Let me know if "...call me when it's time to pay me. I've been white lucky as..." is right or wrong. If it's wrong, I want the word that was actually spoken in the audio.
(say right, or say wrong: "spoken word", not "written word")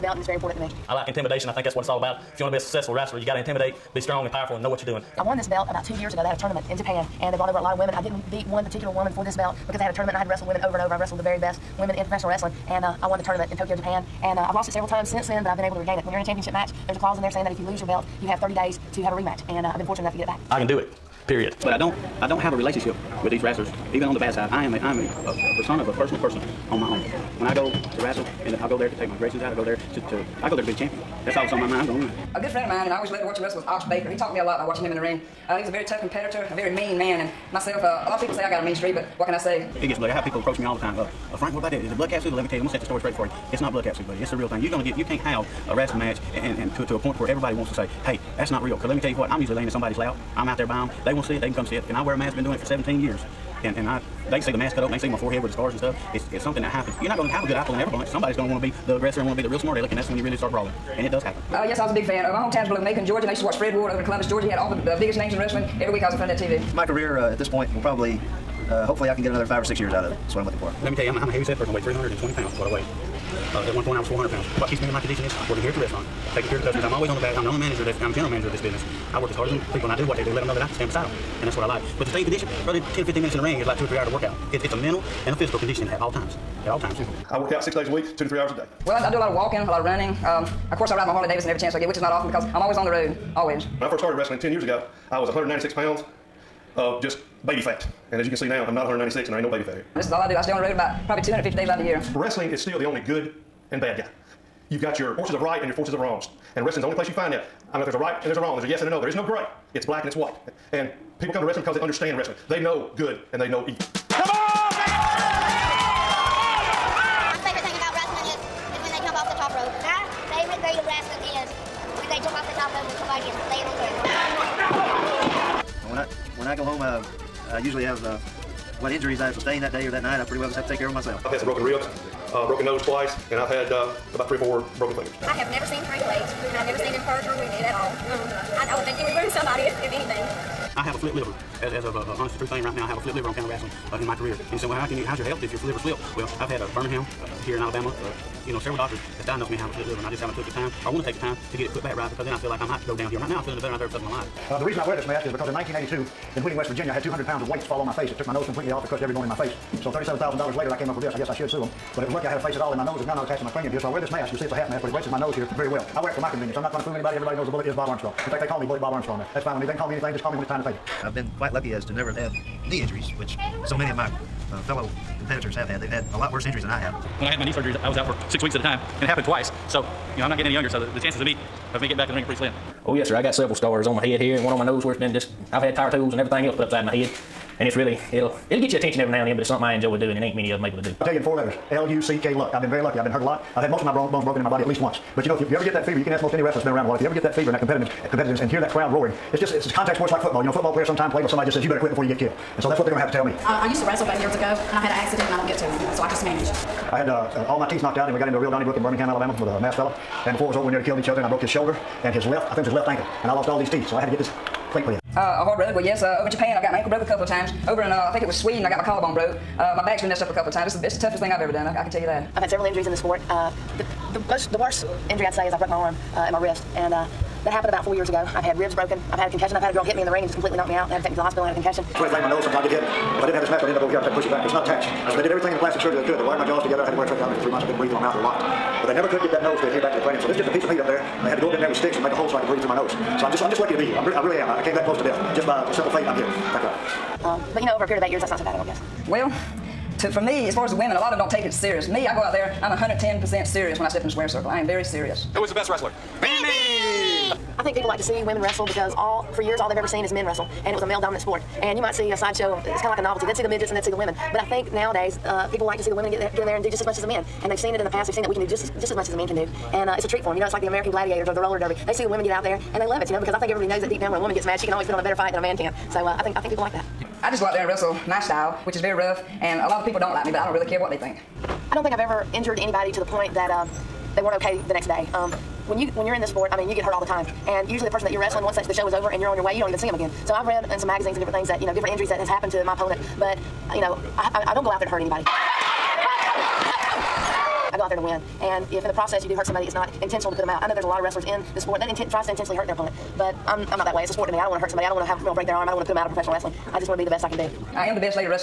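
wrong: "quite", not "white".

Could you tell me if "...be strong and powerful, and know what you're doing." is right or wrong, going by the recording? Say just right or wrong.
right.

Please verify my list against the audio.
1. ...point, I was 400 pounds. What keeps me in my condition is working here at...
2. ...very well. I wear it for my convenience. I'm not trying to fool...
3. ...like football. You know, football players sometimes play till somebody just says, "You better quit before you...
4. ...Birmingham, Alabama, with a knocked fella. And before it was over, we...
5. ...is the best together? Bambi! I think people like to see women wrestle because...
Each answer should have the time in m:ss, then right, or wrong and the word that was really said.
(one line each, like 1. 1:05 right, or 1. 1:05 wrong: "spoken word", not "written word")
1. 1:13 right
2. 2:45 right
3. 3:20 right
4. 3:28 wrong: "masked", not "knocked"
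5. 4:15 wrong: "wrestler", not "together".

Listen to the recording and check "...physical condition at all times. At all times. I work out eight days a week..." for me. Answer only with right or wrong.
wrong.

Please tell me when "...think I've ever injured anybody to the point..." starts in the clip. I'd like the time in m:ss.
4:41.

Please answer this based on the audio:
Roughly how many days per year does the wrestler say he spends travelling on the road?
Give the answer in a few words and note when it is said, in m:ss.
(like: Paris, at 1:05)
250, at 1:41.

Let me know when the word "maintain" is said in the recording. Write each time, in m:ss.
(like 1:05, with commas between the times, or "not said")
not said.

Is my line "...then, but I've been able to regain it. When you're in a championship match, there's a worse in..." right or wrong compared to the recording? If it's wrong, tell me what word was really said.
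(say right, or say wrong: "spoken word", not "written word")
wrong: "clause", not "worse".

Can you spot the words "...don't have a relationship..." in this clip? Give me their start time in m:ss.
0:22.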